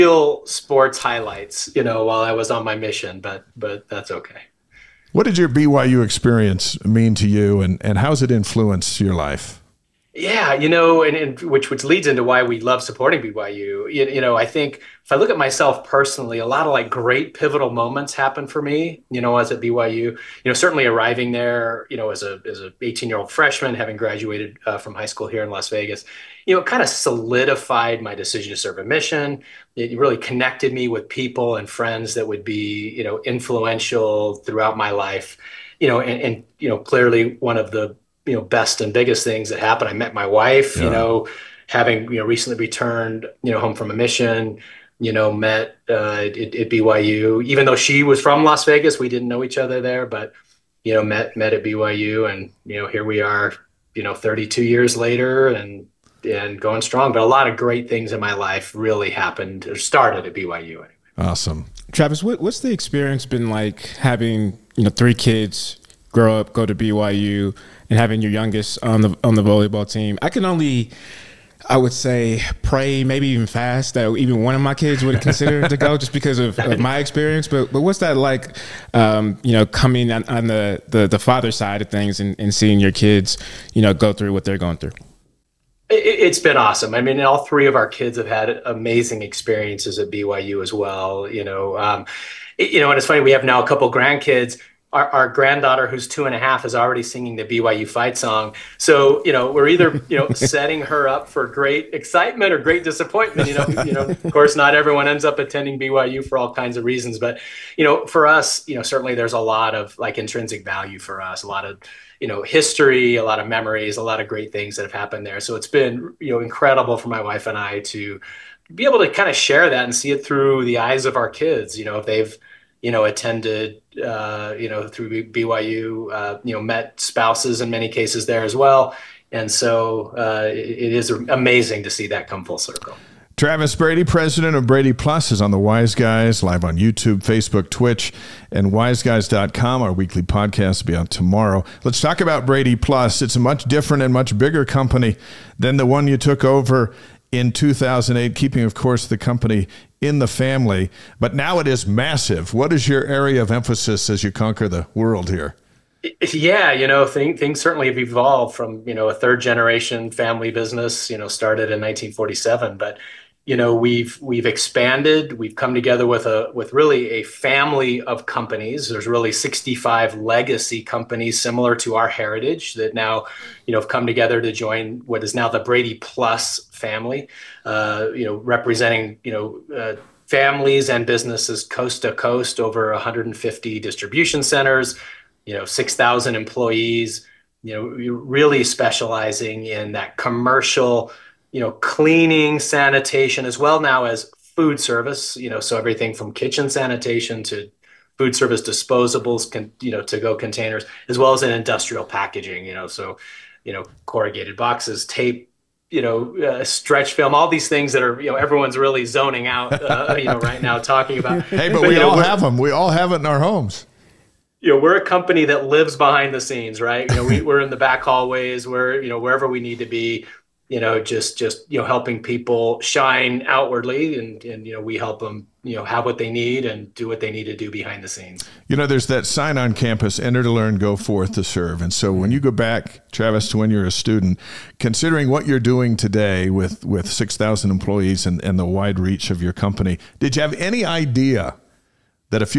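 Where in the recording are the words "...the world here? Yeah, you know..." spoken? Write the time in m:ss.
2:34.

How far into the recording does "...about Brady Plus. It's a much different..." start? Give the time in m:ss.
2:22.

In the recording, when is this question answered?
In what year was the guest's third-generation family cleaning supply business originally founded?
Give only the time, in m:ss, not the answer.
2:41.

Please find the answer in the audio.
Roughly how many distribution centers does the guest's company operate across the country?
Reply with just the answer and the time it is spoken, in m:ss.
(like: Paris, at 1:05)
150, at 3:02.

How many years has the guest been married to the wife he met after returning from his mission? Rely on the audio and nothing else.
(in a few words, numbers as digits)
32.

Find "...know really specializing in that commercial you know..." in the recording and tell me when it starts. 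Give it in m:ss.
3:07.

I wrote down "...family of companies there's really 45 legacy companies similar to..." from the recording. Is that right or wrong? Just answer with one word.
wrong.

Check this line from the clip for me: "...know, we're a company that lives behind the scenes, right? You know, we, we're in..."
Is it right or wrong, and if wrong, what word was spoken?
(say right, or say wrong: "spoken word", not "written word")
right.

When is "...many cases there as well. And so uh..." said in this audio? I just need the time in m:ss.
2:07.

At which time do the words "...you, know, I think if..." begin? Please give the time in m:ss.
0:14.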